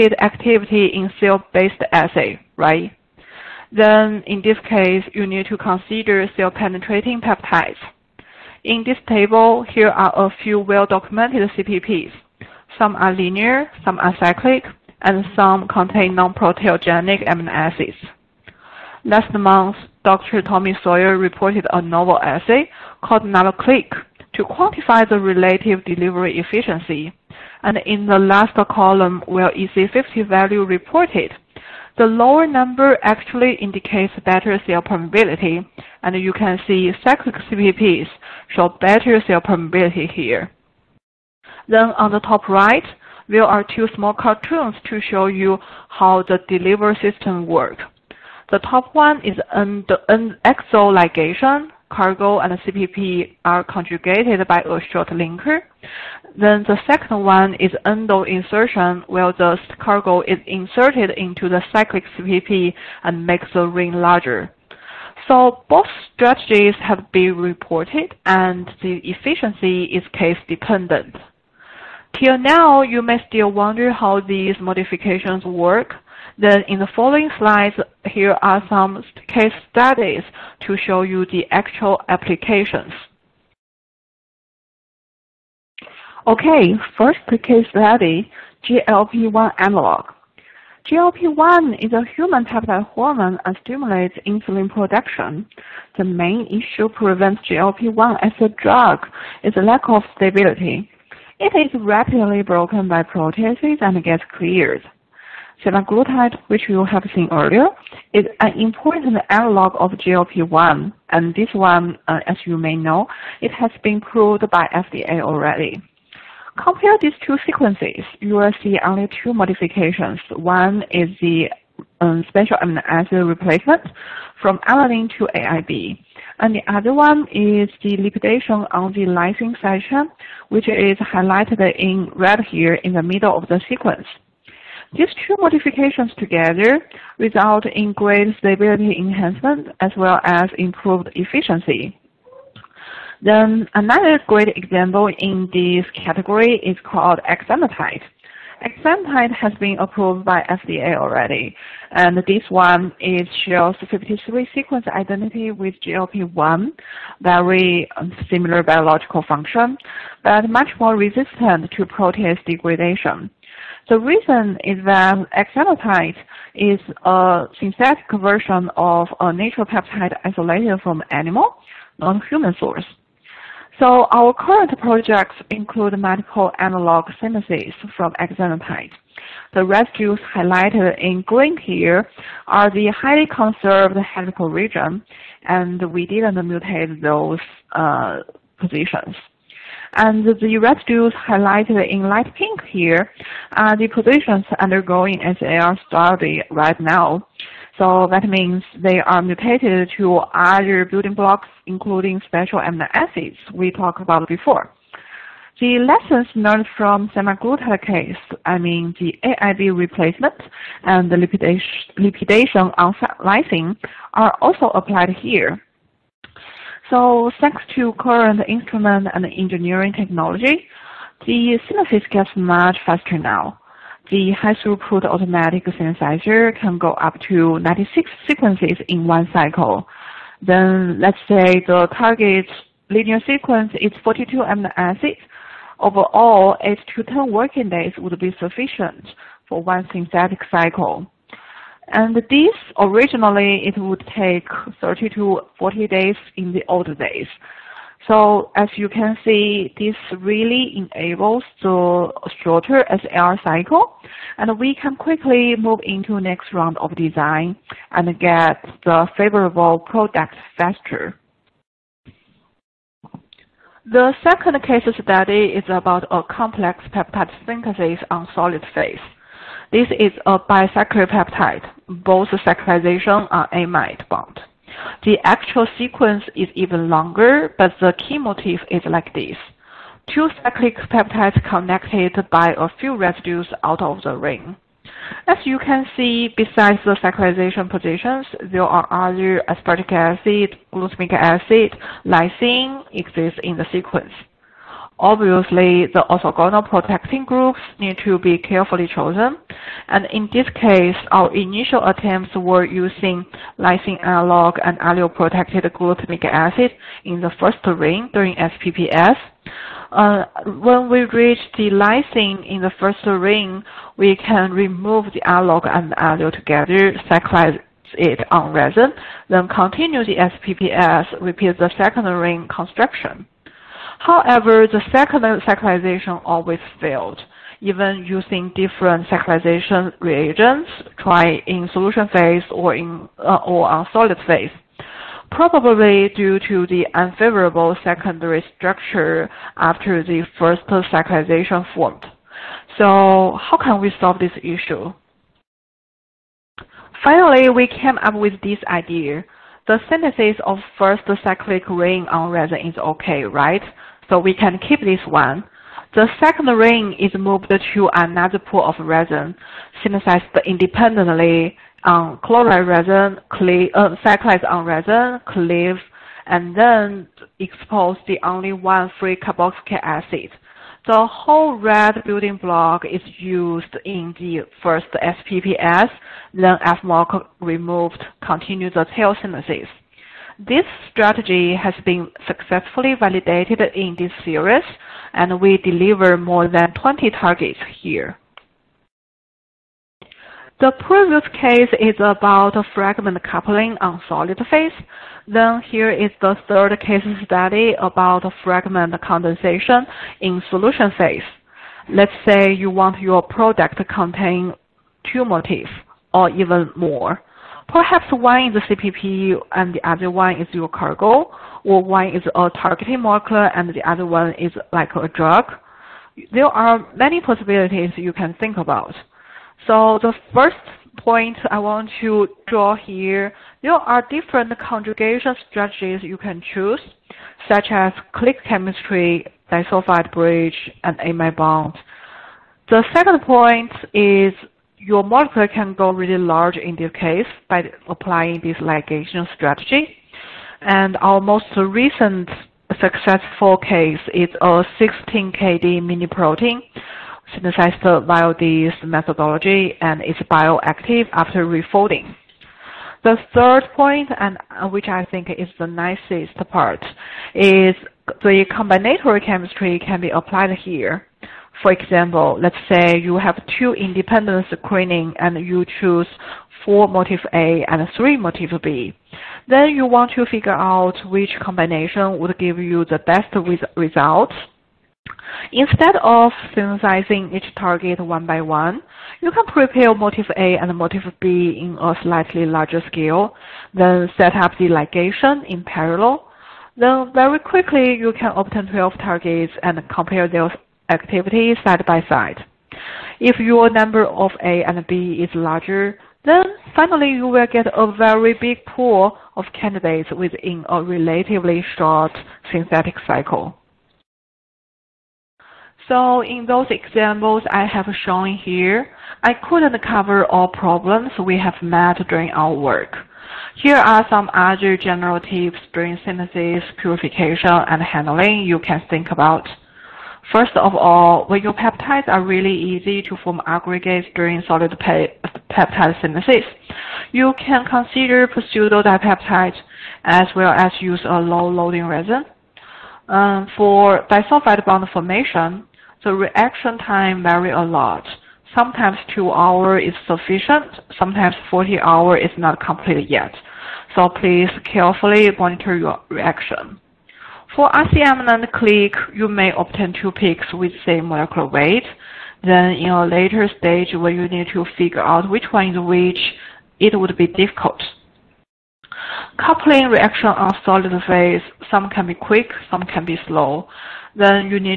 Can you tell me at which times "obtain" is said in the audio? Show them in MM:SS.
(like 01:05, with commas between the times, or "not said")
08:08, 09:09.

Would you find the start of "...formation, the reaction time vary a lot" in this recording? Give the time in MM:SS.
08:54.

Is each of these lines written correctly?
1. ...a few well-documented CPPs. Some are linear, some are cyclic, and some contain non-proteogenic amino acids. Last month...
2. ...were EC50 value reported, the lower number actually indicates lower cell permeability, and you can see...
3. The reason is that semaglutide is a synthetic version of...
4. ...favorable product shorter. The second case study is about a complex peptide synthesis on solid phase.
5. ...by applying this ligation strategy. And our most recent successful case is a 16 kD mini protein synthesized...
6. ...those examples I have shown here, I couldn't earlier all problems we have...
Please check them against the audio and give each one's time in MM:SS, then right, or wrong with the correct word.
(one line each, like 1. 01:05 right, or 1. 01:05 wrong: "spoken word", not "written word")
1. 00:10 right
2. 00:29 wrong: "better", not "lower"
3. 02:43 wrong: "exenatide", not "semaglutide"
4. 04:19 wrong: "faster", not "shorter"
5. 07:17 right
6. 08:26 wrong: "cover", not "earlier".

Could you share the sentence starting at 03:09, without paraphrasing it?
And the residues highlighted in light pink here are the positions undergoing SAR study right now.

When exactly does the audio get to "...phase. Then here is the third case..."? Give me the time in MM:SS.
06:34.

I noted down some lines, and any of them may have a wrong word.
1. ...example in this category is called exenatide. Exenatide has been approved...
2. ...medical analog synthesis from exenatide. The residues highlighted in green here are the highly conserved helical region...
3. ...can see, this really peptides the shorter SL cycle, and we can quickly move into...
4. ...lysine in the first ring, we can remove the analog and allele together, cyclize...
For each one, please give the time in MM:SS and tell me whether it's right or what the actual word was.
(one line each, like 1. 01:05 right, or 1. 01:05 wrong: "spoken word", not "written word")
1. 02:24 right
2. 02:55 right
3. 04:08 wrong: "enables", not "peptides"
4. 05:11 right.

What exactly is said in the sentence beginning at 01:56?
Compare these two sequences, you will see only two modifications.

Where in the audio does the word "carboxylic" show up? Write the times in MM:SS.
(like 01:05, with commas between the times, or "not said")
06:09.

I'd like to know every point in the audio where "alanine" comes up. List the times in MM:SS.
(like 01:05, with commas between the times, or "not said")
02:04.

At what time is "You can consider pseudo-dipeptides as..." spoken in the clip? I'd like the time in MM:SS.
08:47.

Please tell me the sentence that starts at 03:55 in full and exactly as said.
Overall, 8 to 10 working days would be sufficient for one synthetic cycle.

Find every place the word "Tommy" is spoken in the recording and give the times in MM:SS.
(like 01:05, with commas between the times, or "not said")
00:20.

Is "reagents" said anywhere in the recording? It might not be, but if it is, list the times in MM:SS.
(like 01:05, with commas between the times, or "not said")
05:29.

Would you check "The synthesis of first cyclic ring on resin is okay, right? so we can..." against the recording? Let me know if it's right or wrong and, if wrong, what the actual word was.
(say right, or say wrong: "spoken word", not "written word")
right.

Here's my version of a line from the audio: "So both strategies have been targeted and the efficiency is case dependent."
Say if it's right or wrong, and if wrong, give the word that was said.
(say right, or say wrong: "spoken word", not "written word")
wrong: "reported", not "targeted".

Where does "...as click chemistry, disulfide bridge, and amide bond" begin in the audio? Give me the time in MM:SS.
07:07.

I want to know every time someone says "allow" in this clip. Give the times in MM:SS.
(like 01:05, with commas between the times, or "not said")
not said.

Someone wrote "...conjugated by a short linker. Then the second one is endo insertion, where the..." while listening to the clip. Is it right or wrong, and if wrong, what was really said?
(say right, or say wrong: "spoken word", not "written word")
right.